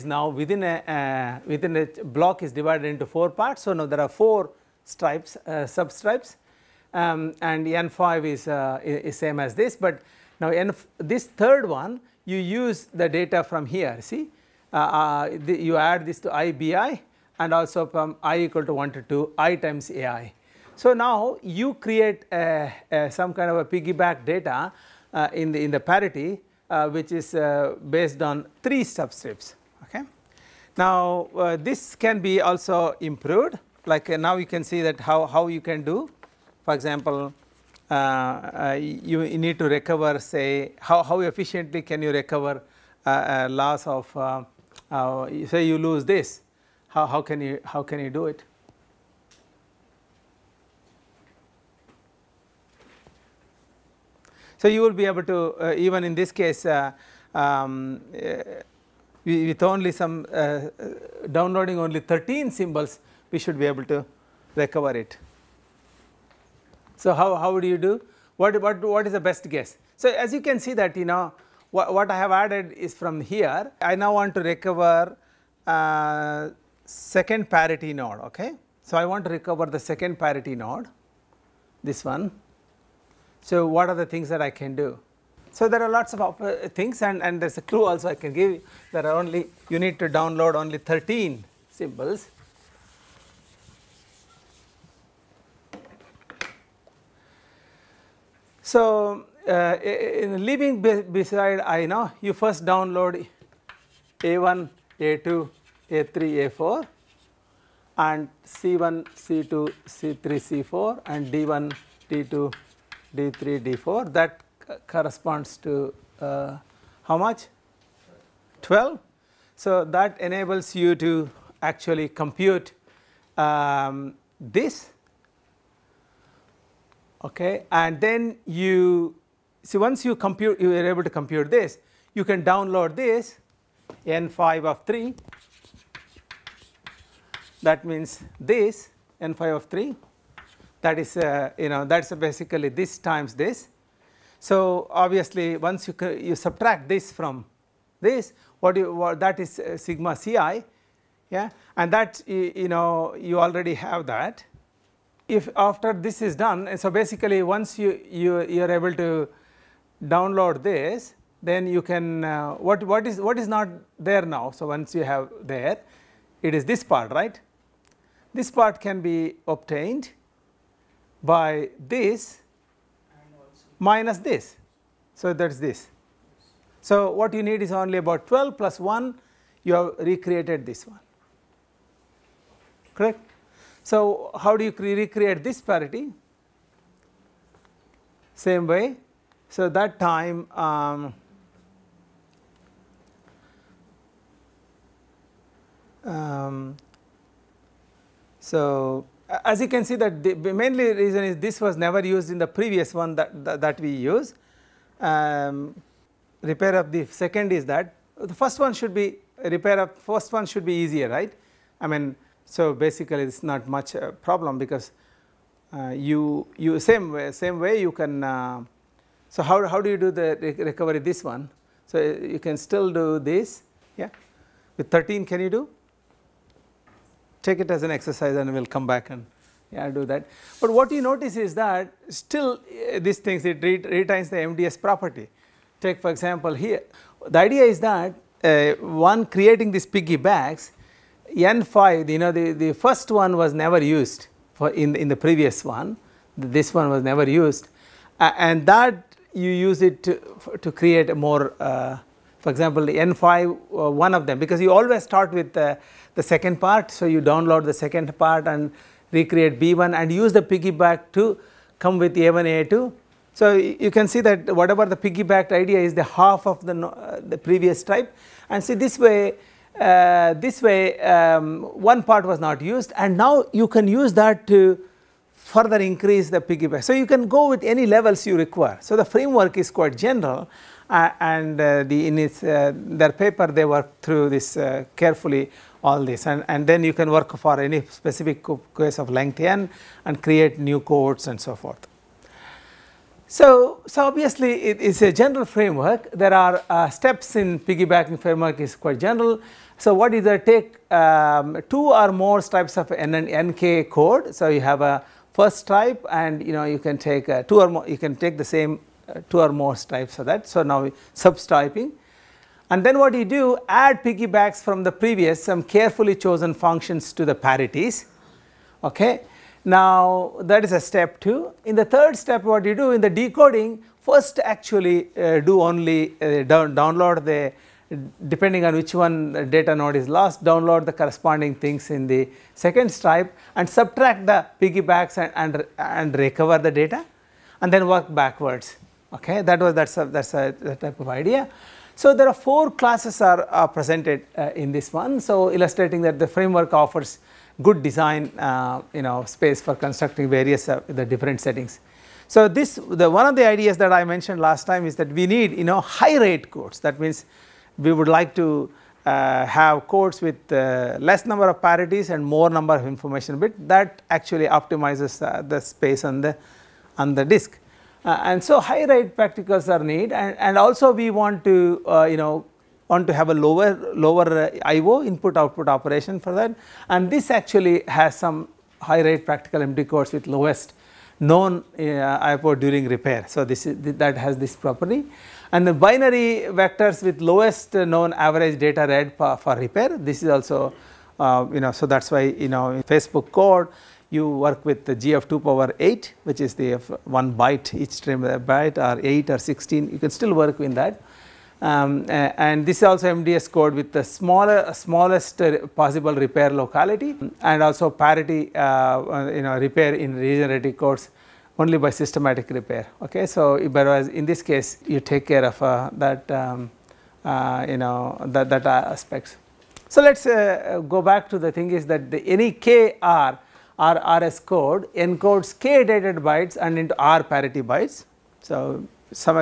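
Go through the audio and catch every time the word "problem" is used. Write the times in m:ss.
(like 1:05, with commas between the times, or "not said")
3:34.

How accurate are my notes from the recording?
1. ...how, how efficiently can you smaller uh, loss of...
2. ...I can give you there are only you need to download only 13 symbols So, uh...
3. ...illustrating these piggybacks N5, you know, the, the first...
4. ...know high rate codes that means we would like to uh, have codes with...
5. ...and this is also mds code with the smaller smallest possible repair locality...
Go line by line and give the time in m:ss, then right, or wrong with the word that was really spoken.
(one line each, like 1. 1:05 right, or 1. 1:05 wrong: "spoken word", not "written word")
1. 0:40 wrong: "recover", not "smaller"
2. 1:28 right
3. 3:59 wrong: "creating", not "illustrating"
4. 5:55 right
5. 6:42 right.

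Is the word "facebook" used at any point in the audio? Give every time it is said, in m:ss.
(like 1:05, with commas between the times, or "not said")
6:32.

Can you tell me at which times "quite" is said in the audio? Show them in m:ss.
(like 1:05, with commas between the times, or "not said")
4:39, 4:58.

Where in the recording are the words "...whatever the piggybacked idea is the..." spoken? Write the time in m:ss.
4:24.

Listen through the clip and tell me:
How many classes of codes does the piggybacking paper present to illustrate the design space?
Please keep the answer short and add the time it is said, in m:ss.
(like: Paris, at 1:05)
4, at 5:42.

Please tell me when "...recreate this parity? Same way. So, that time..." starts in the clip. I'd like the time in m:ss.
3:04.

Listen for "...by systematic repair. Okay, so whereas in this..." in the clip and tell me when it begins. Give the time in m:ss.
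6:51.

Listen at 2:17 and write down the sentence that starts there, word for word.
That means this n5 of 3 that is uh, you know that is basically this times this.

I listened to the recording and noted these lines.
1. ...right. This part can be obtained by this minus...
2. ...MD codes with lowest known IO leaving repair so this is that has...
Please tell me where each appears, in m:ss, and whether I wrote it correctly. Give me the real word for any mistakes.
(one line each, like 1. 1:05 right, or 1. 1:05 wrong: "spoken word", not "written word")
1. 2:47 right
2. 6:19 wrong: "during", not "leaving".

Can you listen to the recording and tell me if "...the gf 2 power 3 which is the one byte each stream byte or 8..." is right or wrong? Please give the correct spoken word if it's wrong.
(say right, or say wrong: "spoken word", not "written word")
wrong: "8", not "3".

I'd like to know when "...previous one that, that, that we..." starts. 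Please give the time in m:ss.
3:22.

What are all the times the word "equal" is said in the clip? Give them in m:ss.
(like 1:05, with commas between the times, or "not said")
0:18.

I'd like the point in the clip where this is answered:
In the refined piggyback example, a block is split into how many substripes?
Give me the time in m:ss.
0:03.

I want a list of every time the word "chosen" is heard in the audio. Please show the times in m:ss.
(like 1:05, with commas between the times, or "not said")
5:16.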